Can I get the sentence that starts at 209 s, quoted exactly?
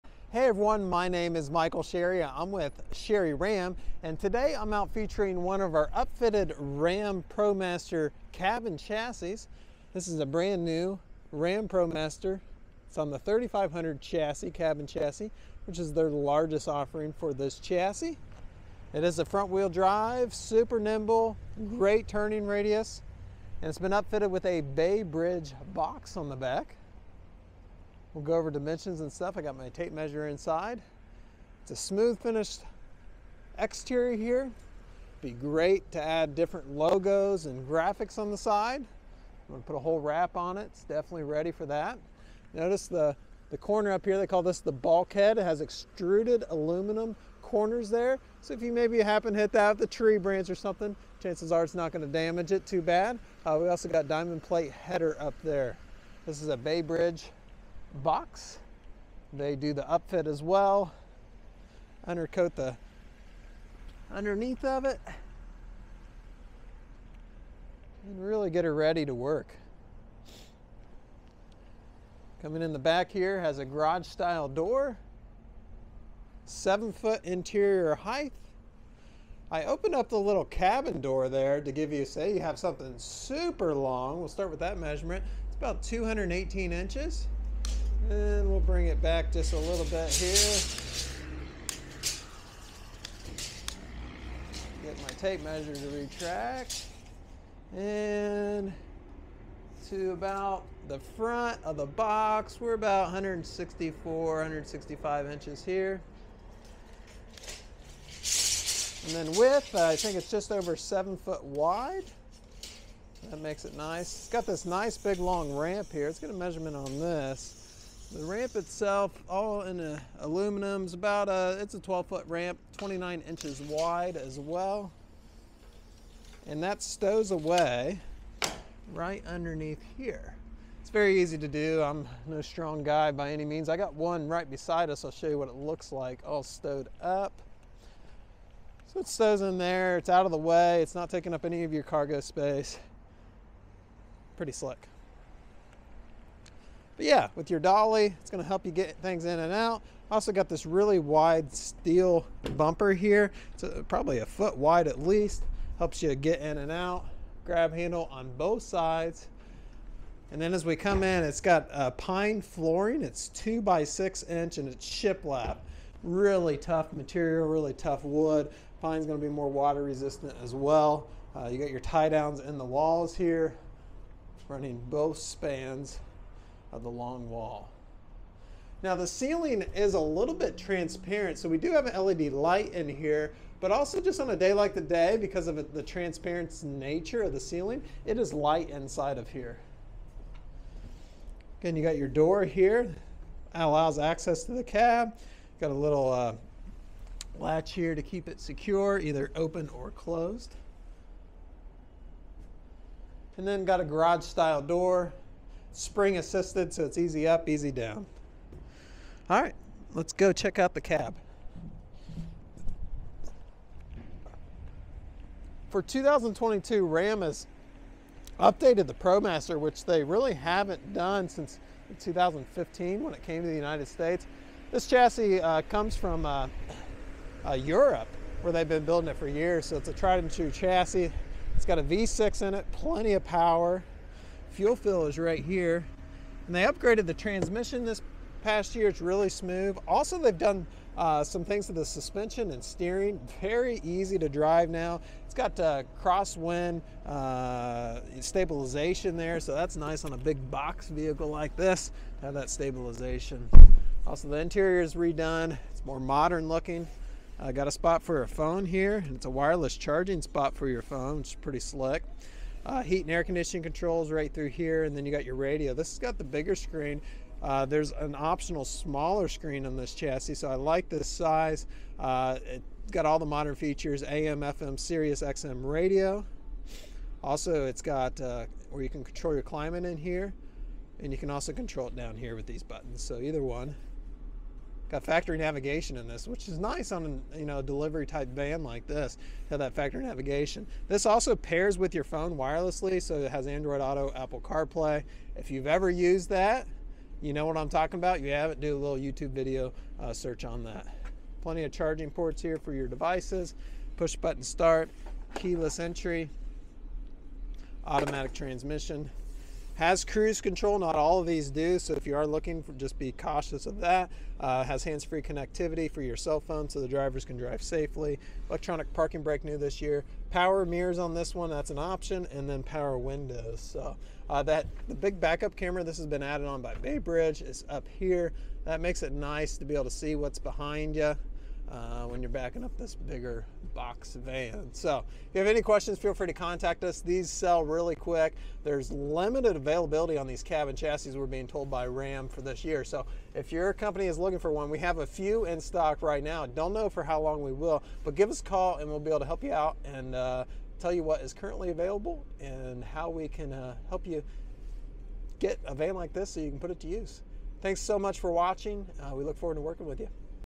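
All right, let's go check out the cab.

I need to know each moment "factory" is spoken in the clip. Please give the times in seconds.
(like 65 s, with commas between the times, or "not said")
285 s, 289 s.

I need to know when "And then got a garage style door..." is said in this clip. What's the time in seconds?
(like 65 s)
203 s.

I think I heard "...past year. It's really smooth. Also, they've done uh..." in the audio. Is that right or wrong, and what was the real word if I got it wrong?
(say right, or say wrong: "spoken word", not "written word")
right.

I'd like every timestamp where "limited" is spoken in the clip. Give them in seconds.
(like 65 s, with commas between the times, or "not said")
338 s.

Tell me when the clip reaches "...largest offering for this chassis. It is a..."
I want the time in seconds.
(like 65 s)
16 s.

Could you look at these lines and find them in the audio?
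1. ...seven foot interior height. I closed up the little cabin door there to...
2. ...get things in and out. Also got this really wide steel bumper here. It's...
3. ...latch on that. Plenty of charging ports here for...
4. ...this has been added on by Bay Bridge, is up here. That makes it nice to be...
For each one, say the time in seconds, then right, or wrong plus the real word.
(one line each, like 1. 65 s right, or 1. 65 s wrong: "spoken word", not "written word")
1. 76 s wrong: "opened", not "closed"
2. 148 s right
3. 300 s wrong: "search", not "latch"
4. 325 s right.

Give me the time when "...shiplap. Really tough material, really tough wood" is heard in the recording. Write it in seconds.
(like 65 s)
164 s.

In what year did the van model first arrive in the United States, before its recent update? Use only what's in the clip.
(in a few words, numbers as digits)
2015.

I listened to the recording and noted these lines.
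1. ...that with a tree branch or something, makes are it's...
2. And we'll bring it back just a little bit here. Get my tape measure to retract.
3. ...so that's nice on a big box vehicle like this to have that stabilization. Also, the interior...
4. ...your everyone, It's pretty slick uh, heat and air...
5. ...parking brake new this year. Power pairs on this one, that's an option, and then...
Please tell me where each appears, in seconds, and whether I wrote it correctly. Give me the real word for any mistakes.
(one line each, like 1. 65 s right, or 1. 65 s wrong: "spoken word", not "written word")
1. 49 s wrong: "chances", not "makes"
2. 88 s right
3. 249 s right
4. 260 s wrong: "phone", not "everyone"
5. 318 s wrong: "mirrors", not "pairs".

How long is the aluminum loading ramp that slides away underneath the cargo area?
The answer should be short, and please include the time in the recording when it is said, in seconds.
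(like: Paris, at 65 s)
12 foot, at 121 s.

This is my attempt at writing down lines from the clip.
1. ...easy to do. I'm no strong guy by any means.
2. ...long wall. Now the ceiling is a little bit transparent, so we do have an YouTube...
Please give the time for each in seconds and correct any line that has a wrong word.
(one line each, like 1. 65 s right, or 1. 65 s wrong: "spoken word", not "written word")
1. 131 s right
2. 176 s wrong: "LED", not "YouTube".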